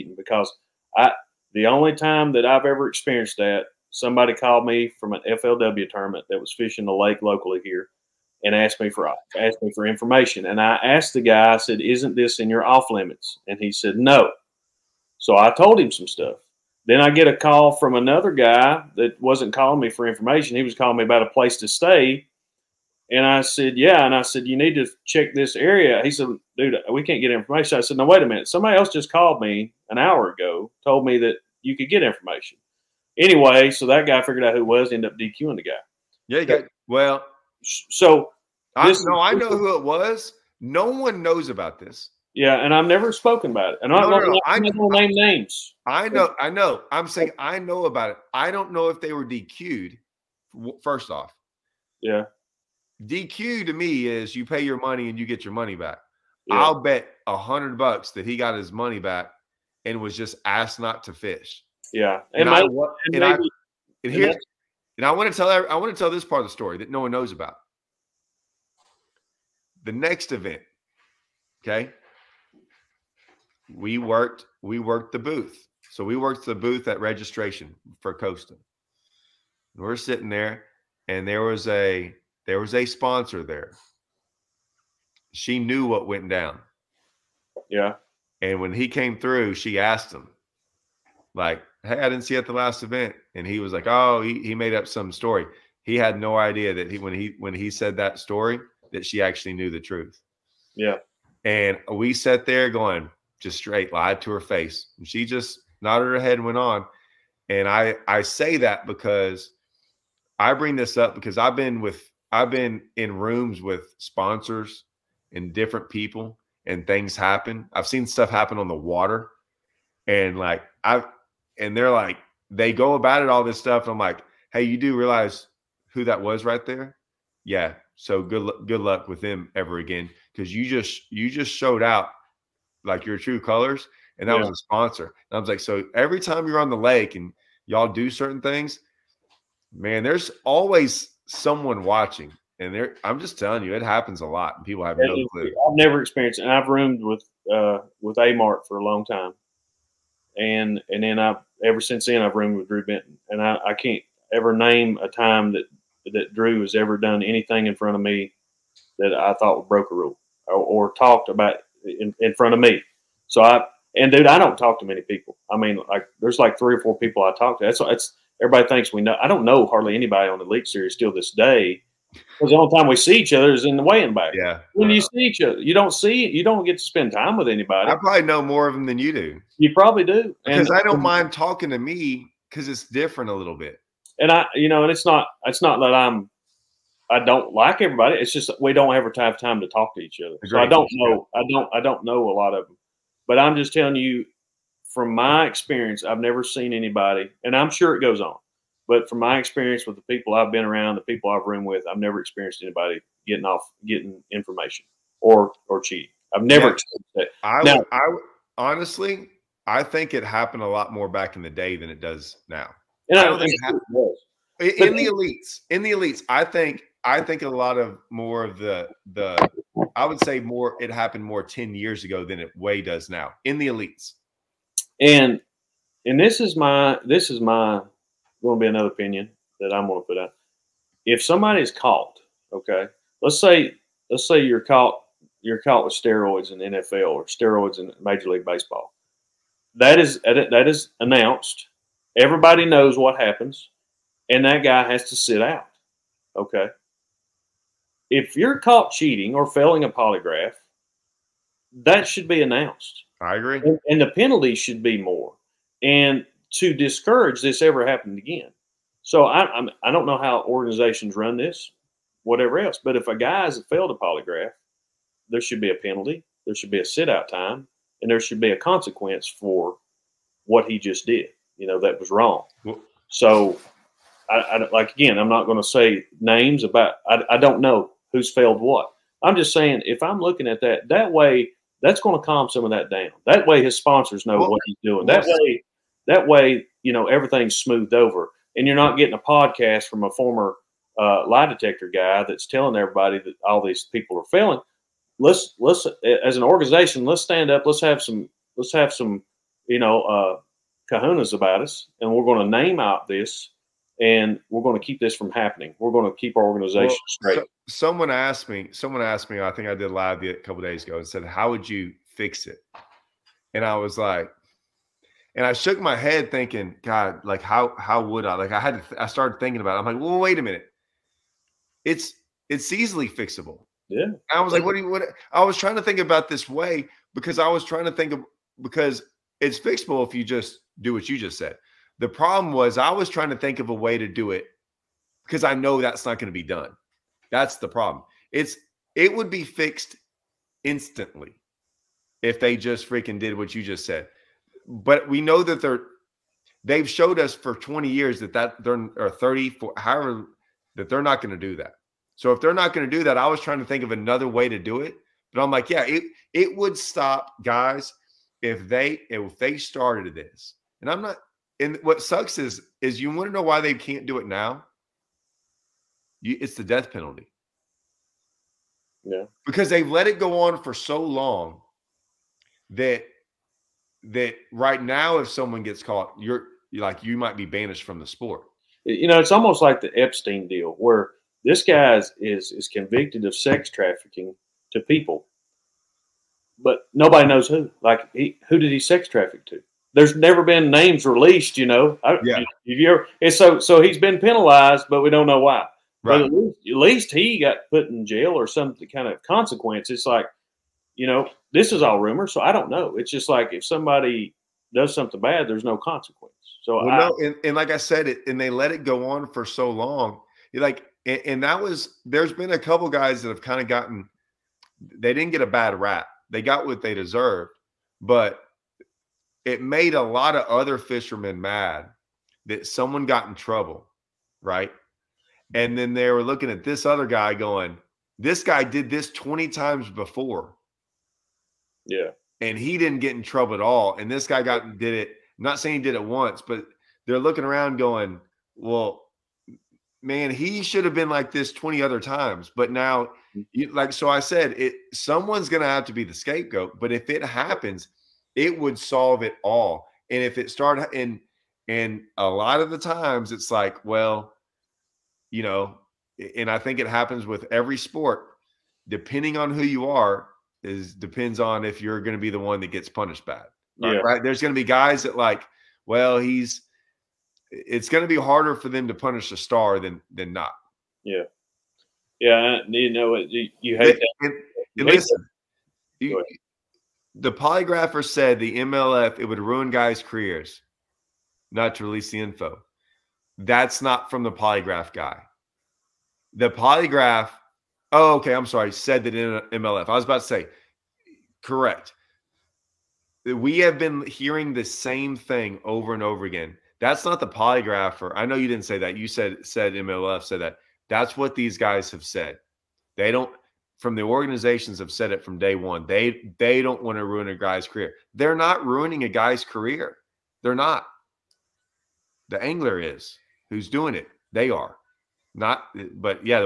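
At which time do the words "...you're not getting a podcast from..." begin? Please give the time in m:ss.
4:48.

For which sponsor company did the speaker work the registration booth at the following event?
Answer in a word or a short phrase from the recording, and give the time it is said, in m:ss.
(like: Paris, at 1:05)
Costa, at 1:18.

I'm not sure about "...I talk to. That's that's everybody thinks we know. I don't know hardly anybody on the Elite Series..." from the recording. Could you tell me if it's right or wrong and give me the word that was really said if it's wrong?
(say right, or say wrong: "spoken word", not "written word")
right.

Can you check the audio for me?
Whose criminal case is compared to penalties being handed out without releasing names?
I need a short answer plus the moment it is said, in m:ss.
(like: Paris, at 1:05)
Epstein, at 6:19.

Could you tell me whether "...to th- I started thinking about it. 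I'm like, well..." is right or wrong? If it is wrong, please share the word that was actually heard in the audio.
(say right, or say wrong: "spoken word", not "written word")
right.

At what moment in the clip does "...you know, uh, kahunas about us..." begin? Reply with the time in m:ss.
4:59.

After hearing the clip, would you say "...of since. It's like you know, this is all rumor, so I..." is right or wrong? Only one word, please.
wrong.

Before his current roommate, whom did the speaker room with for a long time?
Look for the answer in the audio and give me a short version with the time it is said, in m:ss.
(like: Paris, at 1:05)
Mark, at 2:28.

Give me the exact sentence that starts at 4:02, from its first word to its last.
Everybody knows what happens, and that guy has to sit out.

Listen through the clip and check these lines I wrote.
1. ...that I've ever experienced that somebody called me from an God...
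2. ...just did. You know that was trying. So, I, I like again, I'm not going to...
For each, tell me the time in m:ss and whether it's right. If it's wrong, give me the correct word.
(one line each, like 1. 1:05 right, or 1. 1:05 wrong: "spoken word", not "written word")
1. 0:02 wrong: "FLW", not "God"
2. 4:30 wrong: "wrong", not "trying".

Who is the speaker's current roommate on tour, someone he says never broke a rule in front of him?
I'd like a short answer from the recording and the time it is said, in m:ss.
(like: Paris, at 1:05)
Drew Benton, at 2:32.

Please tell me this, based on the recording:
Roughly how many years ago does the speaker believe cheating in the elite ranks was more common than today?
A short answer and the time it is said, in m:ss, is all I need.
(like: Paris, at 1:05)
10 years, at 3:41.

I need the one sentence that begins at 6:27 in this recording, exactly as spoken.
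Like, he, who did he sex traffic to?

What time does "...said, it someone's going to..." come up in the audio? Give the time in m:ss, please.
7:24.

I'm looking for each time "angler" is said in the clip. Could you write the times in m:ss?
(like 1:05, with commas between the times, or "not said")
8:32.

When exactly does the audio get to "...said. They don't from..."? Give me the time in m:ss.
8:22.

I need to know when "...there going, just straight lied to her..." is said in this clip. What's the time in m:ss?
1:42.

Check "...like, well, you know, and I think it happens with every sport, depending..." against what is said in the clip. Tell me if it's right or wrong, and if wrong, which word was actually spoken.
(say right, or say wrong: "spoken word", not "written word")
right.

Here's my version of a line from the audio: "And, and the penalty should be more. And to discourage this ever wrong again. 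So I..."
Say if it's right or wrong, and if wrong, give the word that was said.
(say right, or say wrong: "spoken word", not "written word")
wrong: "happening", not "wrong".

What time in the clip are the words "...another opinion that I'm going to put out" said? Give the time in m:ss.
3:48.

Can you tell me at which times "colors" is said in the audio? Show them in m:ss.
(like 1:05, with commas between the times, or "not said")
2:13.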